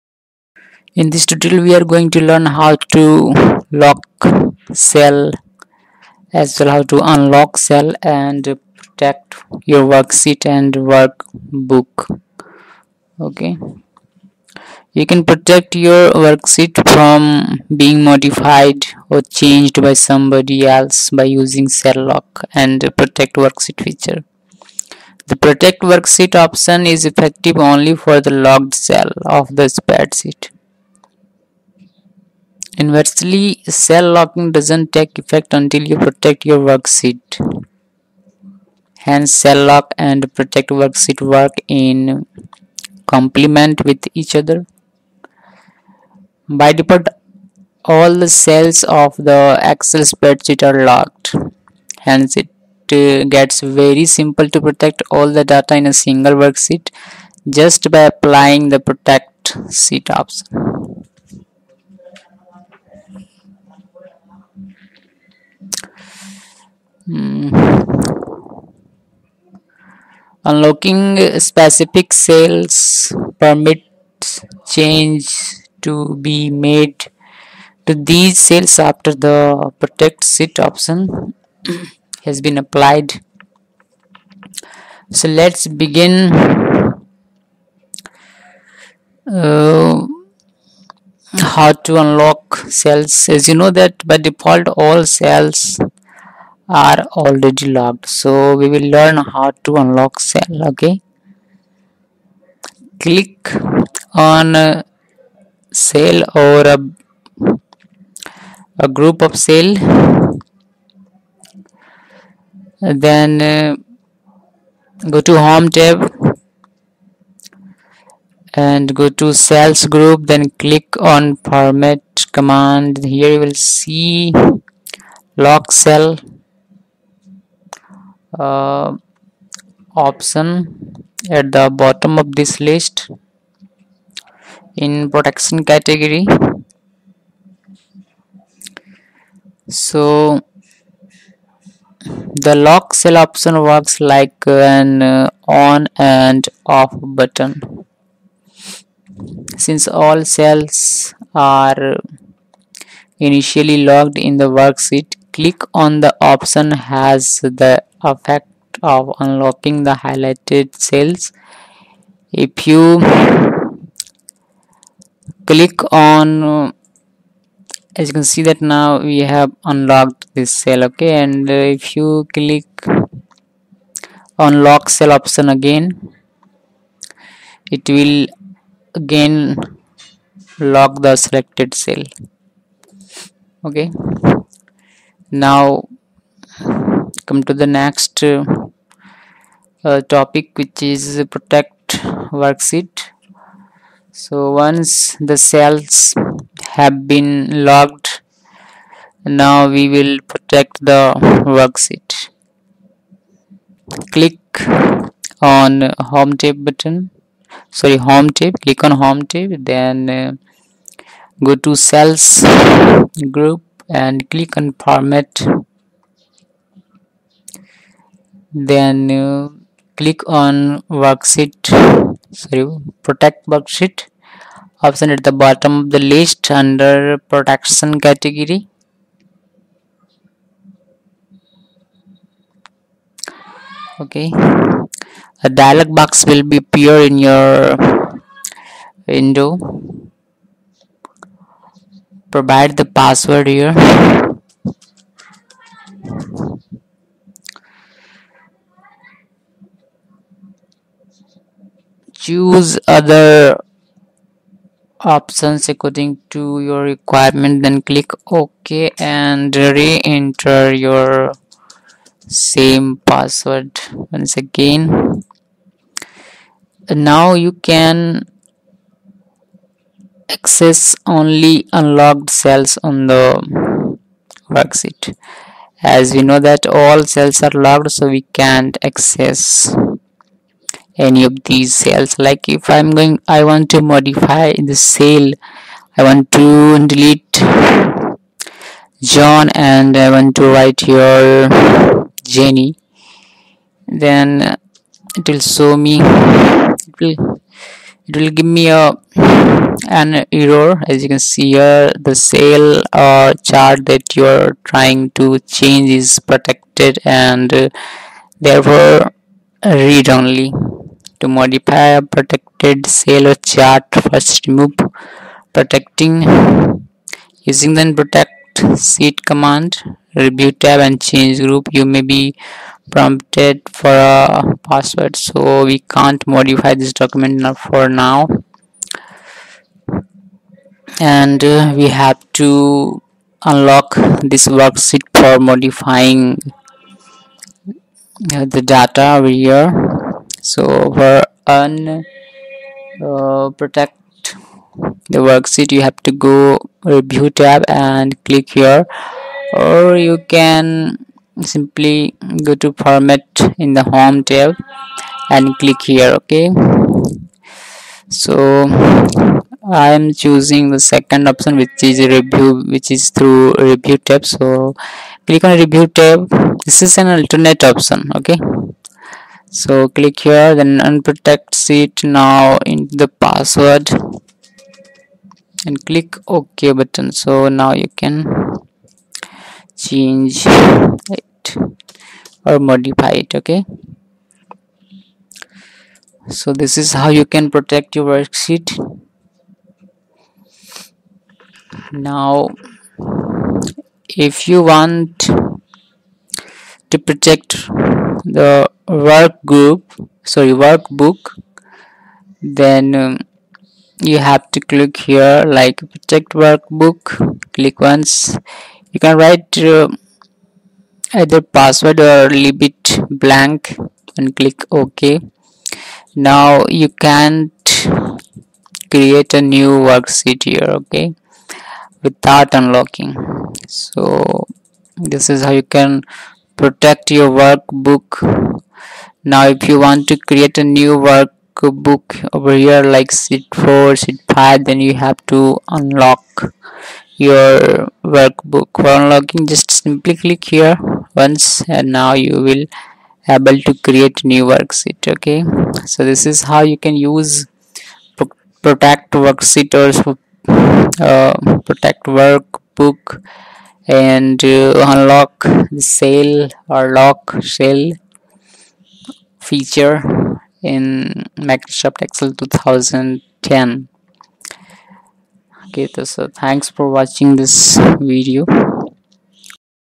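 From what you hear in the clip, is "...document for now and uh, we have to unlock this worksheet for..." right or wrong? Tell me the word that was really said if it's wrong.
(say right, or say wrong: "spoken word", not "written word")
right.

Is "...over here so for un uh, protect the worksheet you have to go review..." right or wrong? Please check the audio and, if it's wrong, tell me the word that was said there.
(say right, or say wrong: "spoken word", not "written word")
right.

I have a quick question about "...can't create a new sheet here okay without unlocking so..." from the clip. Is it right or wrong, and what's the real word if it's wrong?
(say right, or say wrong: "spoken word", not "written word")
wrong: "worksheet", not "sheet".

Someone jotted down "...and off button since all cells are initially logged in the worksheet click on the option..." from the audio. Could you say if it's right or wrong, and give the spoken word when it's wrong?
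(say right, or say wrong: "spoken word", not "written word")
right.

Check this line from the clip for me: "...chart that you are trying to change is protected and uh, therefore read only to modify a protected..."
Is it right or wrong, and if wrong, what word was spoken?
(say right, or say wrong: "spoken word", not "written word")
right.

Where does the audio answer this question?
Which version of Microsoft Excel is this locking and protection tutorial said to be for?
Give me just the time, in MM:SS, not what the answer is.
07:41.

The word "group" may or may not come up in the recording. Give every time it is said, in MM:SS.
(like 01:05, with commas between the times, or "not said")
01:48, 01:59, 03:33, 05:21, 06:39.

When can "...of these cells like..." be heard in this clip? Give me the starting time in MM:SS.
04:41.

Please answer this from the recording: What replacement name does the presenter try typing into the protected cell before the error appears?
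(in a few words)
Jenny.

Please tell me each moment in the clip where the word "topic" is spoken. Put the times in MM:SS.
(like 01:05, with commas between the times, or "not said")
03:10.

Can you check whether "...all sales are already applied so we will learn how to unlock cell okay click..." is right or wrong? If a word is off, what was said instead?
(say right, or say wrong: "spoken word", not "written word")
wrong: "locked", not "applied".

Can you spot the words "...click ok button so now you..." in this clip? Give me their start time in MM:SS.
06:15.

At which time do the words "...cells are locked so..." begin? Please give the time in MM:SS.
04:37.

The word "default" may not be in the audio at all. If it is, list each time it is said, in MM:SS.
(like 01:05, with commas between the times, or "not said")
00:46, 01:34.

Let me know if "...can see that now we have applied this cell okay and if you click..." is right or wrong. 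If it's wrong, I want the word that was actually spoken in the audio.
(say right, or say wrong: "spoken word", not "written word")
wrong: "unlocked", not "applied".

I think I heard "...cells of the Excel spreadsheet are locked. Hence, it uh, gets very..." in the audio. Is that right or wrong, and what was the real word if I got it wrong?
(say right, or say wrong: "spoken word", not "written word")
right.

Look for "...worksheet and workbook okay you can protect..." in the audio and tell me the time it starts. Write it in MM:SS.
00:09.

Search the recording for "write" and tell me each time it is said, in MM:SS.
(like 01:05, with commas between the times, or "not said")
04:50, 06:49.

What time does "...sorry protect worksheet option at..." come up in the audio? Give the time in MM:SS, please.
03:42.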